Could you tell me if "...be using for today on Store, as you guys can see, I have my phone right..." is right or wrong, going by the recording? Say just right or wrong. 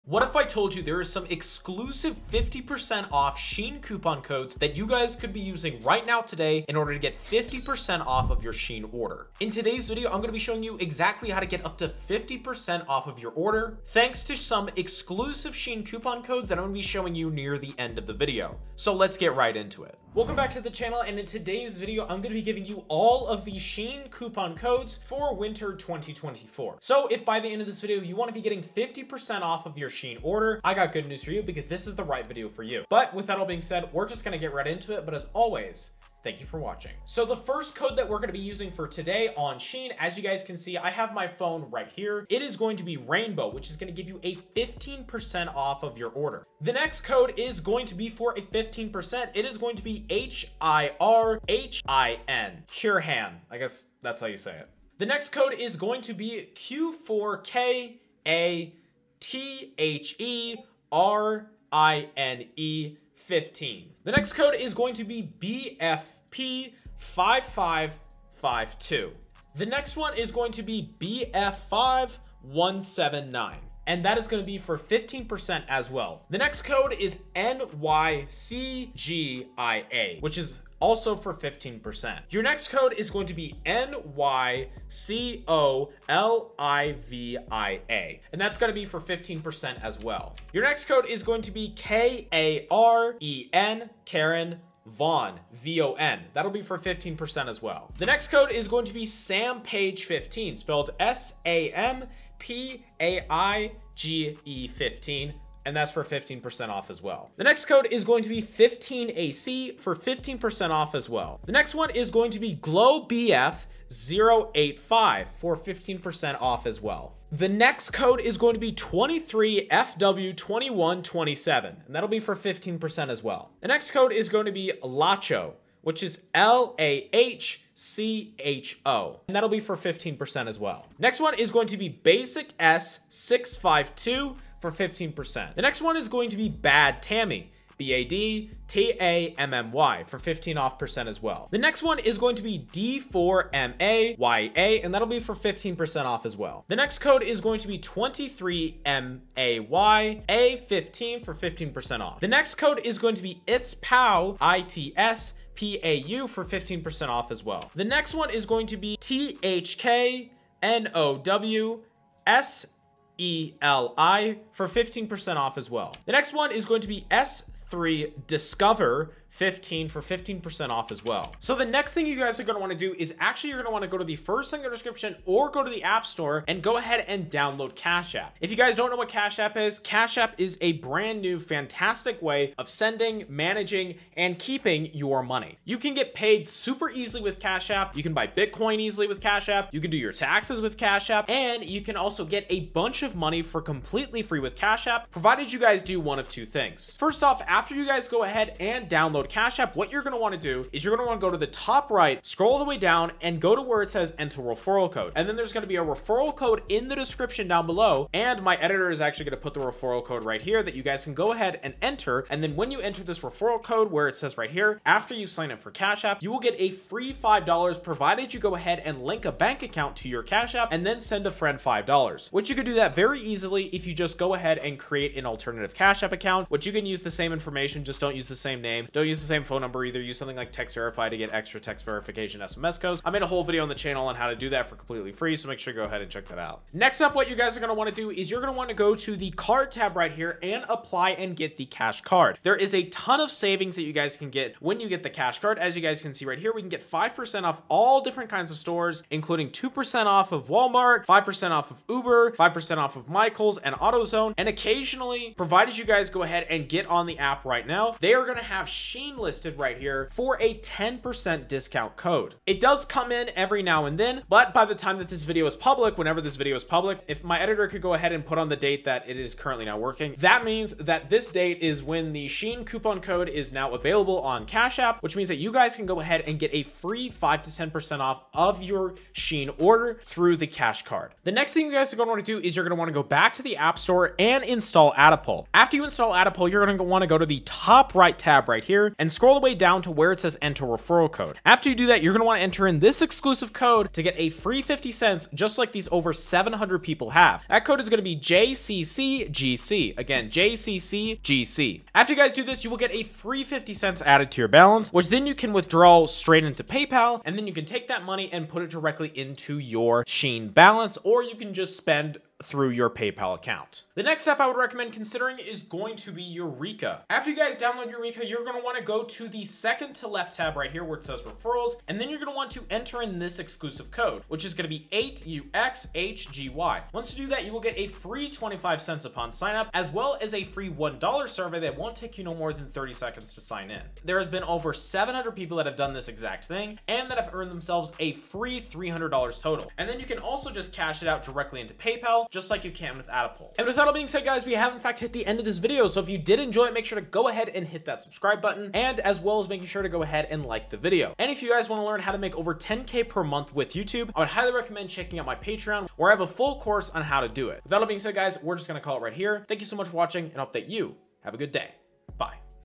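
wrong.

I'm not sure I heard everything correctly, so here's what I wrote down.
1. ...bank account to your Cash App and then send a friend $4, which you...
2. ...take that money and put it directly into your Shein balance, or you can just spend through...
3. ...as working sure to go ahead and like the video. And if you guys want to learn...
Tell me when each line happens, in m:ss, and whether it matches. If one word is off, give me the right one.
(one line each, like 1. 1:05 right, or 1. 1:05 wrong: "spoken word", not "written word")
1. 3:39 wrong: "5", not "4"
2. 5:07 right
3. 5:49 wrong: "making", not "working".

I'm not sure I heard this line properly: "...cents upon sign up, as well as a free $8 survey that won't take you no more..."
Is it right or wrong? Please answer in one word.
wrong.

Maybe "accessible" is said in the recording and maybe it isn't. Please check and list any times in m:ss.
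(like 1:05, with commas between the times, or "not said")
not said.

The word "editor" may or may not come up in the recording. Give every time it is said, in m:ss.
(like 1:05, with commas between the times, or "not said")
3:28, 4:27.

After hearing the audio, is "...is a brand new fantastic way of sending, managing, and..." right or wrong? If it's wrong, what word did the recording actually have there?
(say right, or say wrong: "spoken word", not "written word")
right.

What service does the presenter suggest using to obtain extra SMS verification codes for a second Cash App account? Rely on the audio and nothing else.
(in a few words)
Text Verify.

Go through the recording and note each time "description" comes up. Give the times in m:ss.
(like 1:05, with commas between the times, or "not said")
2:54, 3:26.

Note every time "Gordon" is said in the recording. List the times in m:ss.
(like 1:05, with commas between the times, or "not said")
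not said.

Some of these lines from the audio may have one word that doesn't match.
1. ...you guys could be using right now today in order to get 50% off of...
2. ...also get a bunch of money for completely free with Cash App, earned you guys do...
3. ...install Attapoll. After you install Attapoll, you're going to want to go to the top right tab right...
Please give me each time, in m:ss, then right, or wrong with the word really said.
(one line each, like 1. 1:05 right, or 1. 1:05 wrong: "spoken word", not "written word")
1. 0:04 right
2. 3:11 wrong: "provided", not "earned"
3. 4:44 right.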